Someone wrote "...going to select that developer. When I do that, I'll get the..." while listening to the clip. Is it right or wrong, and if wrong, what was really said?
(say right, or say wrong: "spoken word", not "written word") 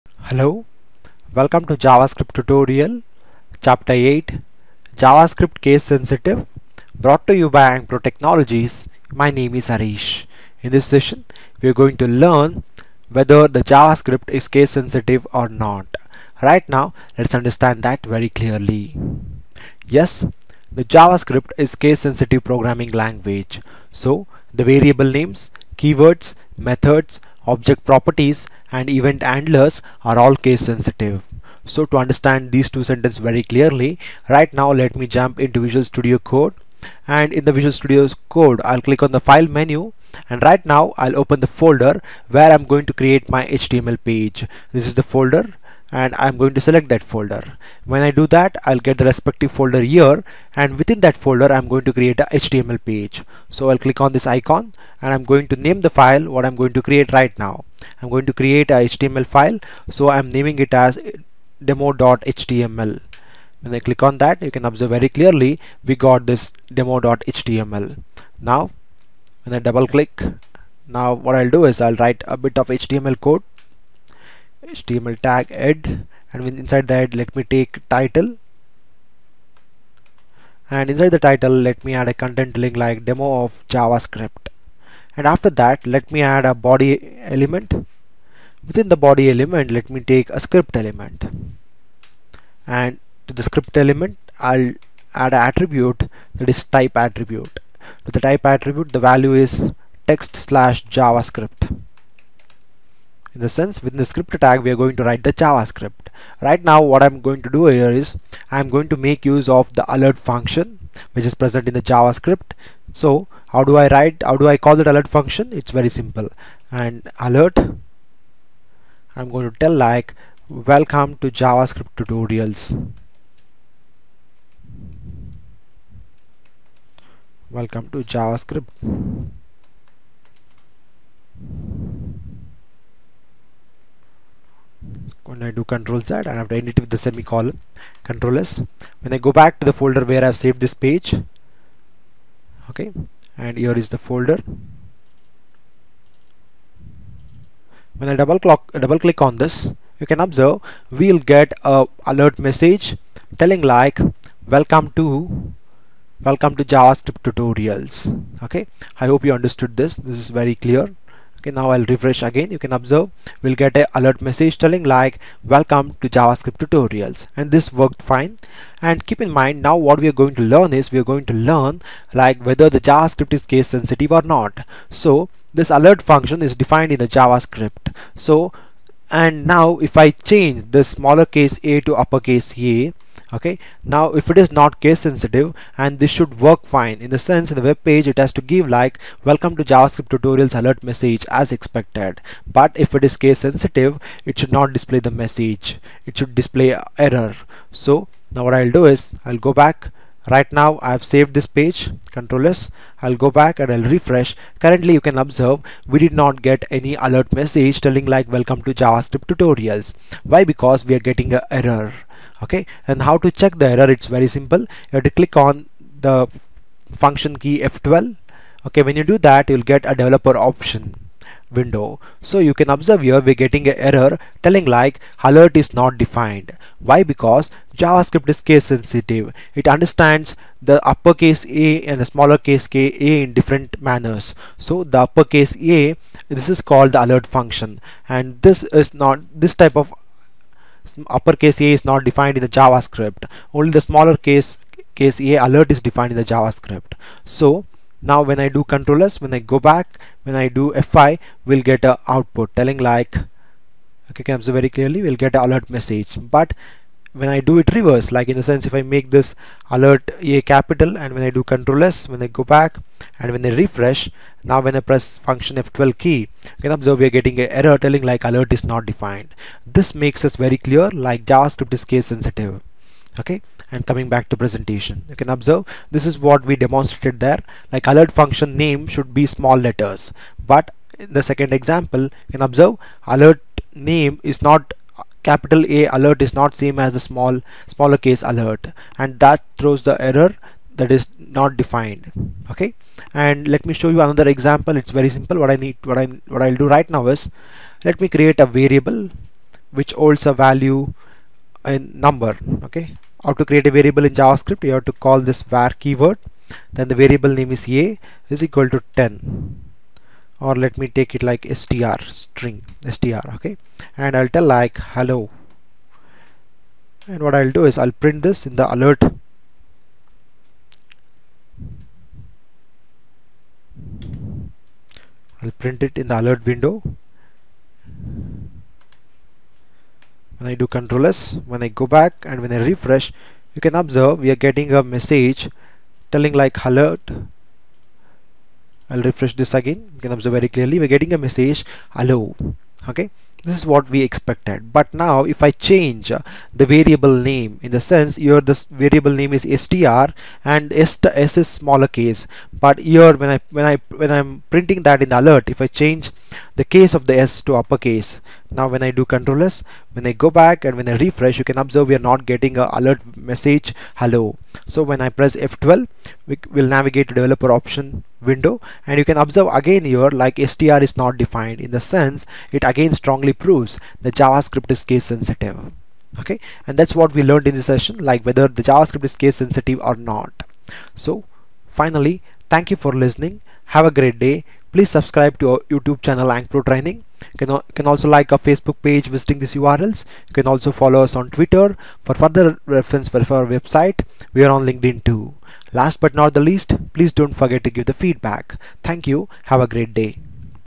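wrong: "folder", not "developer".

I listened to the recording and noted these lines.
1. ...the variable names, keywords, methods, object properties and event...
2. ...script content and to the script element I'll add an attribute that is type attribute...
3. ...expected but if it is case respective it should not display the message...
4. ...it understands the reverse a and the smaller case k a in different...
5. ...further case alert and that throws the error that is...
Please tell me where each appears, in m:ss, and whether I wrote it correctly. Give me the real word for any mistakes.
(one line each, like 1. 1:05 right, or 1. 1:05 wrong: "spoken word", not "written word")
1. 0:24 right
2. 1:30 wrong: "element", not "content"
3. 3:11 wrong: "sensitive", not "respective"
4. 3:49 wrong: "uppercase", not "reverse"
5. 4:47 wrong: "smaller", not "further".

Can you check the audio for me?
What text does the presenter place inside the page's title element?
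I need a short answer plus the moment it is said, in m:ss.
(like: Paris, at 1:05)
demo of javascript, at 1:23.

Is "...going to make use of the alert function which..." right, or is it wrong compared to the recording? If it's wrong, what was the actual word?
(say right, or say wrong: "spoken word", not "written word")
right.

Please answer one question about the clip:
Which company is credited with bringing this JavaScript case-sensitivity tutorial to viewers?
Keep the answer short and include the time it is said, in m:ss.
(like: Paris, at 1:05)
Ankpro Technologies, at 0:07.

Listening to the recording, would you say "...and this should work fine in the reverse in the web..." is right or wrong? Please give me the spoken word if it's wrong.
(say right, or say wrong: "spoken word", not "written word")
wrong: "sense", not "reverse".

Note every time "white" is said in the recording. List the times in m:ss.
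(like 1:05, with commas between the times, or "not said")
not said.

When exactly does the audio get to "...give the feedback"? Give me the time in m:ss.
6:37.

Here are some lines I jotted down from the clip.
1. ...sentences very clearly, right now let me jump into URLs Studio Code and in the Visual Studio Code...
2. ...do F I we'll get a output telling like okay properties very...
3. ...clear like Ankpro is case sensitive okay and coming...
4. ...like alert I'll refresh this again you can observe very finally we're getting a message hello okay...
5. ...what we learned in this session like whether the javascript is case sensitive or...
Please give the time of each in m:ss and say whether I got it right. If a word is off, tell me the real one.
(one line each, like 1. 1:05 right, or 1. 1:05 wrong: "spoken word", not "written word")
1. 0:32 wrong: "Visual", not "URLs"
2. 4:10 wrong: "comes", not "properties"
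3. 4:30 wrong: "JavaScript", not "Ankpro"
4. 5:36 wrong: "clearly", not "finally"
5. 6:16 right.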